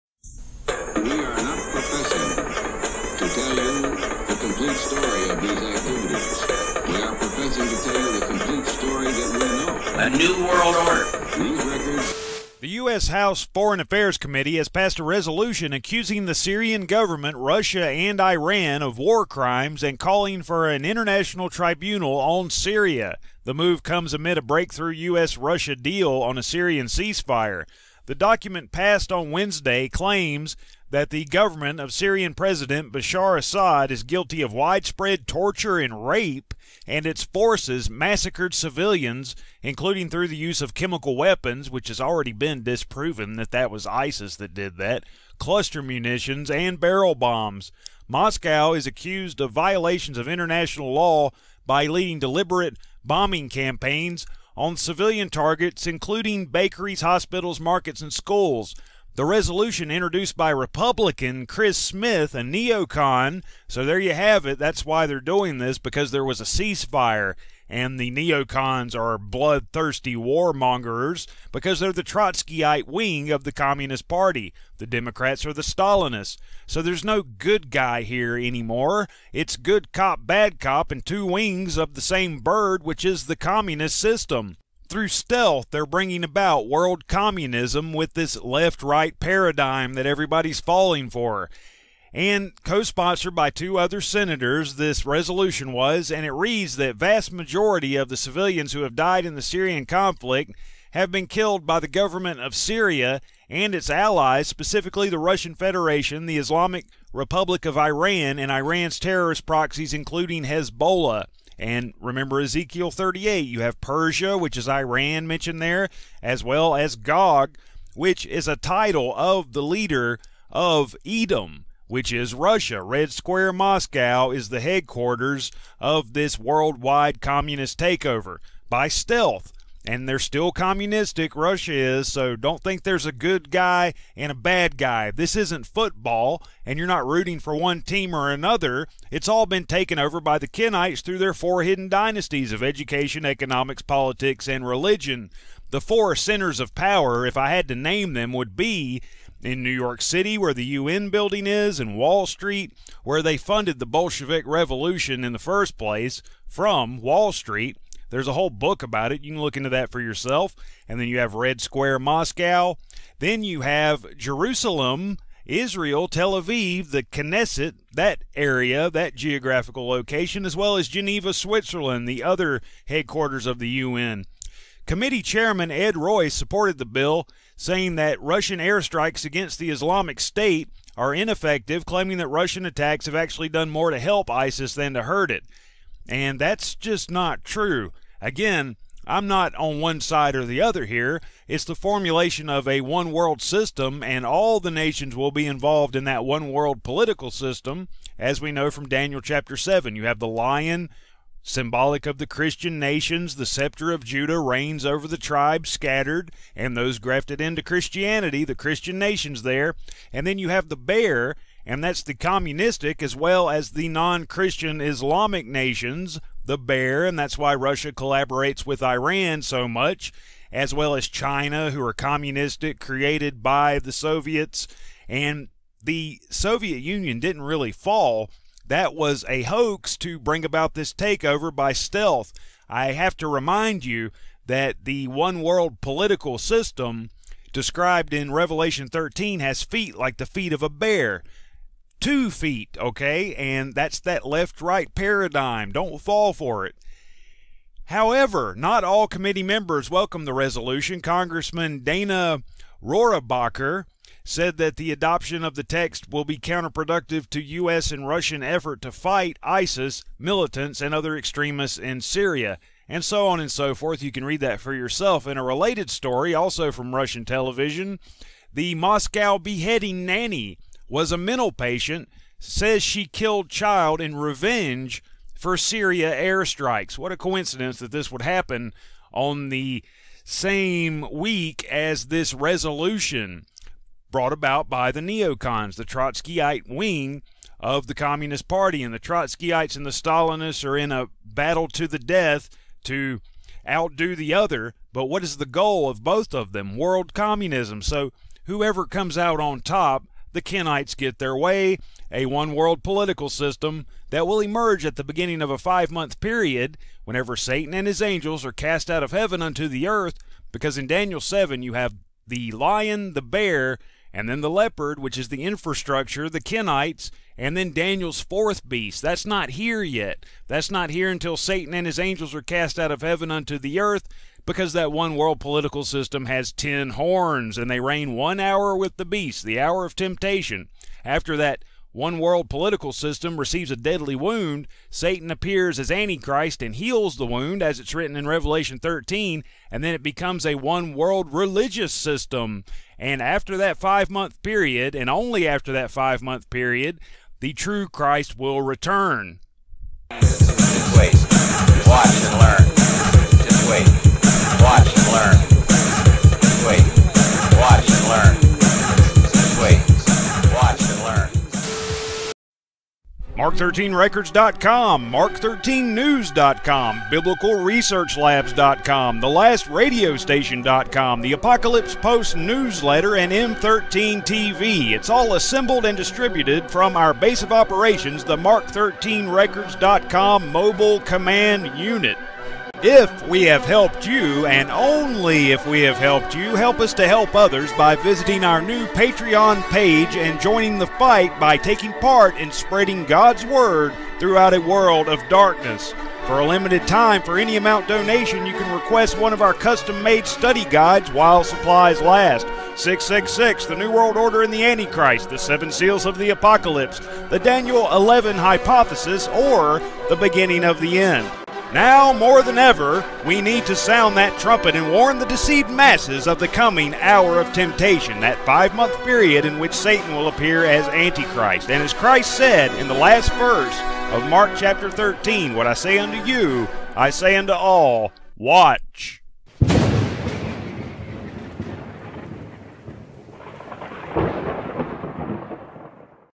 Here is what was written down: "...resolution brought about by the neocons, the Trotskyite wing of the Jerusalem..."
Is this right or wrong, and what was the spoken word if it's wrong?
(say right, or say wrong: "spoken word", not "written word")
wrong: "Communist", not "Jerusalem".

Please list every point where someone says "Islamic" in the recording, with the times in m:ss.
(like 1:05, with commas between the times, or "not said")
1:46, 2:59, 3:34.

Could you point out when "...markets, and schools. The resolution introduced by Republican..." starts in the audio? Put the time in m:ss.
0:57.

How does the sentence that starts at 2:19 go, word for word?
It's all been taken over by the Kenites through their four hidden dynasties of education, economics, politics, and religion.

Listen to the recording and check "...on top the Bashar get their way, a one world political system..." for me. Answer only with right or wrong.
wrong.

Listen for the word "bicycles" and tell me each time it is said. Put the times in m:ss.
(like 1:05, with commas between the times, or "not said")
not said.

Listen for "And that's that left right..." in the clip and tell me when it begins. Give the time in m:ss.
4:03.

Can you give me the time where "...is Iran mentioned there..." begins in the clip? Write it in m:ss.
1:54.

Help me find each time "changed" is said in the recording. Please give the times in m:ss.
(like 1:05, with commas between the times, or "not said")
not said.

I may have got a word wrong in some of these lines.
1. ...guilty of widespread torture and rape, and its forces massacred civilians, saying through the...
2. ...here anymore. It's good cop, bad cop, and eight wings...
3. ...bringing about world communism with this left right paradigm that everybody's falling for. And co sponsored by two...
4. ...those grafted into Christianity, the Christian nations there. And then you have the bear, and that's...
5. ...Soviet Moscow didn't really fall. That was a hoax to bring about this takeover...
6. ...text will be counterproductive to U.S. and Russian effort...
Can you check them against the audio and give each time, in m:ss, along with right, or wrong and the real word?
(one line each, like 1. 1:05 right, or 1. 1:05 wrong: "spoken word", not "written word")
1. 0:34 wrong: "including", not "saying"
2. 1:18 wrong: "two", not "eight"
3. 1:25 right
4. 3:26 right
5. 3:46 wrong: "Union", not "Moscow"
6. 4:15 right.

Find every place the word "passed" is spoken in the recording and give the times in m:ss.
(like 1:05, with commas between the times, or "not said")
0:14, 0:28.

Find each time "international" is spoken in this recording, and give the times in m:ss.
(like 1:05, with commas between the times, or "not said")
0:20, 0:50.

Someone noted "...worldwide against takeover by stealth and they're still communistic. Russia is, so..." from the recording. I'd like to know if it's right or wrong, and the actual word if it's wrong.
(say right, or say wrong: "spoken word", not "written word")
wrong: "communist", not "against".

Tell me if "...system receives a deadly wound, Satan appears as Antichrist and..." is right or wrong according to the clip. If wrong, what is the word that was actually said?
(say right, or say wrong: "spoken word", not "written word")
right.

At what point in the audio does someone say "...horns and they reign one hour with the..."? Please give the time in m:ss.
5:26.